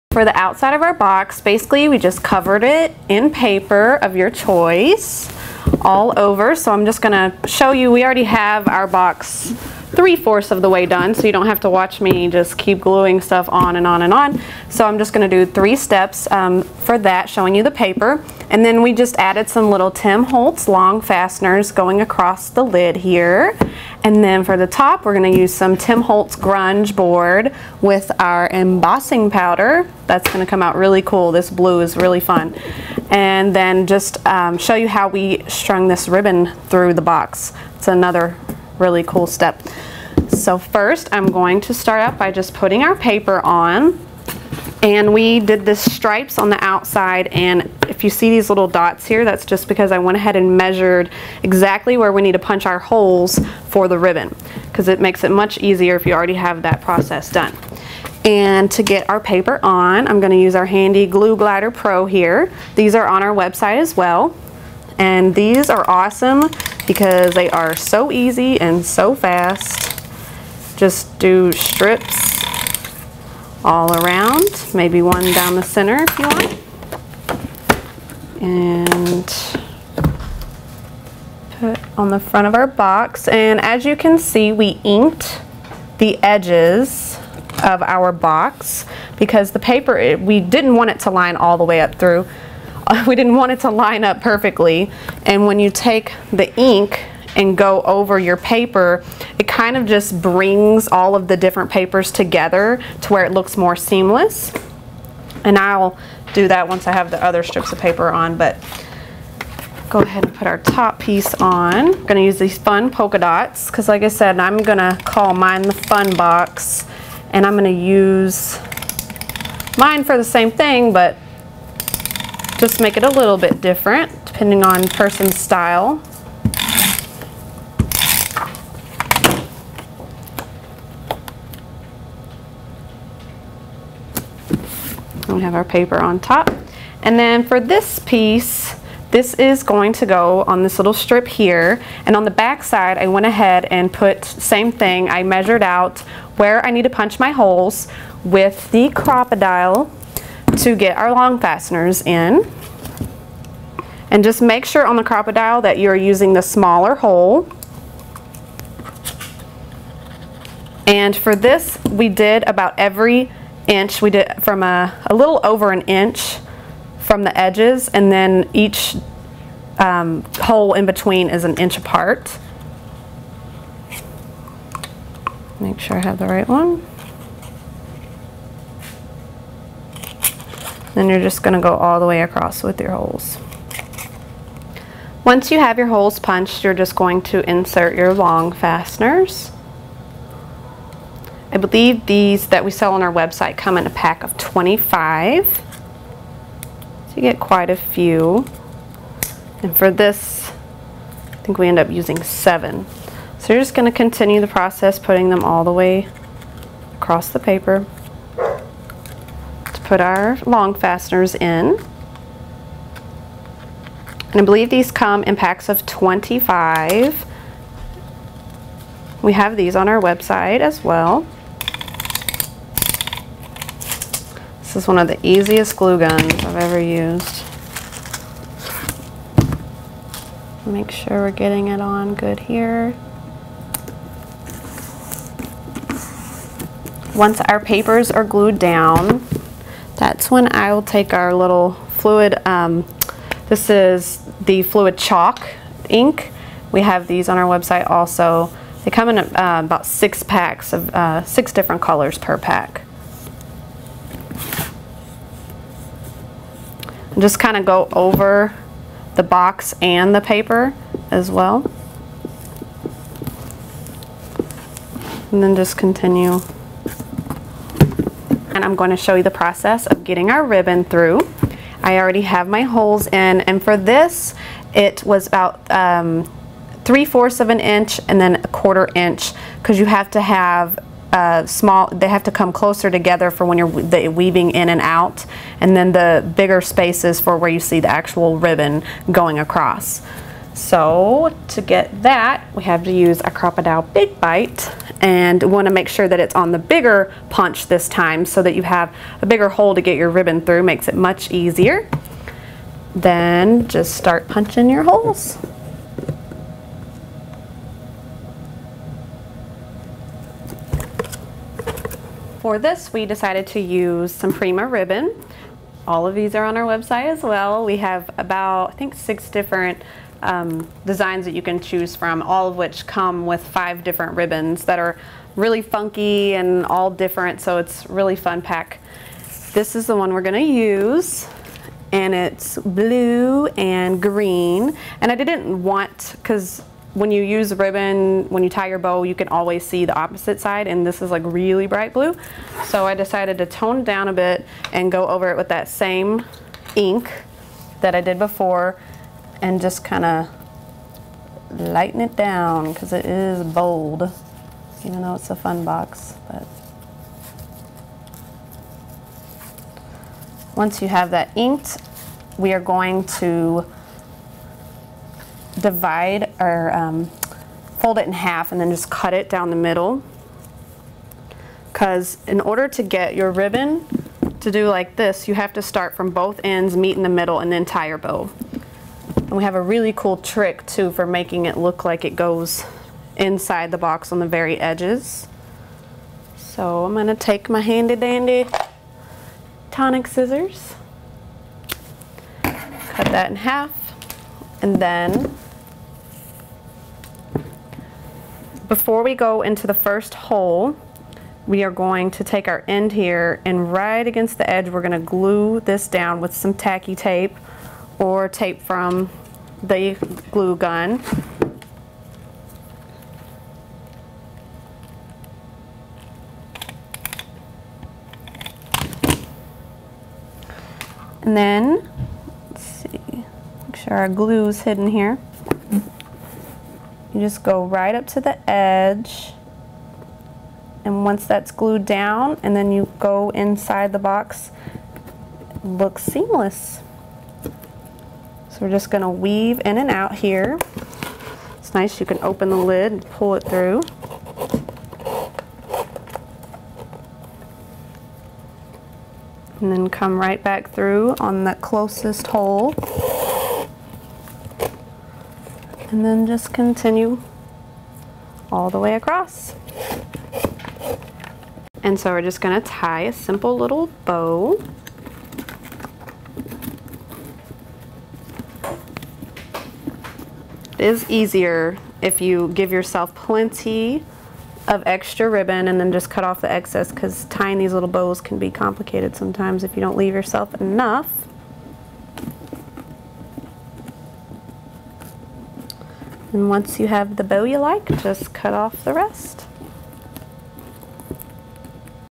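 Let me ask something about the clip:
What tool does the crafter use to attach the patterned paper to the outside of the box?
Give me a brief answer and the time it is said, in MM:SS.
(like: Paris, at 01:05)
Glue Glider Pro, at 01:01.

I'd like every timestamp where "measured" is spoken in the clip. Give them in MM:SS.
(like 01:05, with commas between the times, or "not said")
00:50, 02:25.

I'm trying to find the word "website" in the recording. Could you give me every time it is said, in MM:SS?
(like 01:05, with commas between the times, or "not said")
01:03, 03:13, 03:40, 04:07, 05:16.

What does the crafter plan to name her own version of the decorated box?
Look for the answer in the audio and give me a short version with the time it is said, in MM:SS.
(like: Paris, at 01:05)
The fun box, at 01:55.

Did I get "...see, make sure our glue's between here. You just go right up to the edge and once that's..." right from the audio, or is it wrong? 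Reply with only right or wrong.
wrong.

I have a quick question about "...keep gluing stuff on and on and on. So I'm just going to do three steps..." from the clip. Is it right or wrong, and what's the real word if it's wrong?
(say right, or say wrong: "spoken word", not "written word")
right.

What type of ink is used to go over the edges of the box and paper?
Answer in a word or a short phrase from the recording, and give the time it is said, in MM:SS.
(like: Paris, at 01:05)
Fluid chalk ink, at 04:04.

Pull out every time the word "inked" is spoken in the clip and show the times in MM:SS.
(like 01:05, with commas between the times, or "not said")
01:24, 06:01.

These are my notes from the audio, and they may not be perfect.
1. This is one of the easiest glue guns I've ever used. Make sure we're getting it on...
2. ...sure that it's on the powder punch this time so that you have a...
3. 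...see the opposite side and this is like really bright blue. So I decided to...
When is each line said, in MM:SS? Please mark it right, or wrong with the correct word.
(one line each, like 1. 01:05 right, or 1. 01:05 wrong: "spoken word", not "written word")
1. 03:44 right
2. 04:55 wrong: "bigger", not "powder"
3. 05:39 right.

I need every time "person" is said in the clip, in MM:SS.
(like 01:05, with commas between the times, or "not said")
02:04.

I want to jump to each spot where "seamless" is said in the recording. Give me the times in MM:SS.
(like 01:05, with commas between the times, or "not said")
01:43, 07:16.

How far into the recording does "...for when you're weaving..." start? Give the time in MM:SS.
04:43.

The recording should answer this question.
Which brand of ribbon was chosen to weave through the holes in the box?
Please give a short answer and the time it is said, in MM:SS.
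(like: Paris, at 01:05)
Prima, at 05:14.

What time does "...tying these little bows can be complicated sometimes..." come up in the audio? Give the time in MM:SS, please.
07:57.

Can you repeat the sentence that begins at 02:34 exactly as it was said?
And just make sure on the Crop-A-Dile that you're using the smaller hole.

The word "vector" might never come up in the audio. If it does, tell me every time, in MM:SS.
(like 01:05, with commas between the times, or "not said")
not said.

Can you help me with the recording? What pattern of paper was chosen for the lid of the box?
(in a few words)
Polka dots.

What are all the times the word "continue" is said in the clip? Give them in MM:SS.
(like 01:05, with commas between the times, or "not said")
03:23, 04:25, 07:36.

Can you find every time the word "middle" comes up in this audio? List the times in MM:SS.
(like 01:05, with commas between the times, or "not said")
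06:09, 06:17.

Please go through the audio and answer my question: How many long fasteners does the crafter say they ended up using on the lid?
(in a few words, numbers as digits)
7.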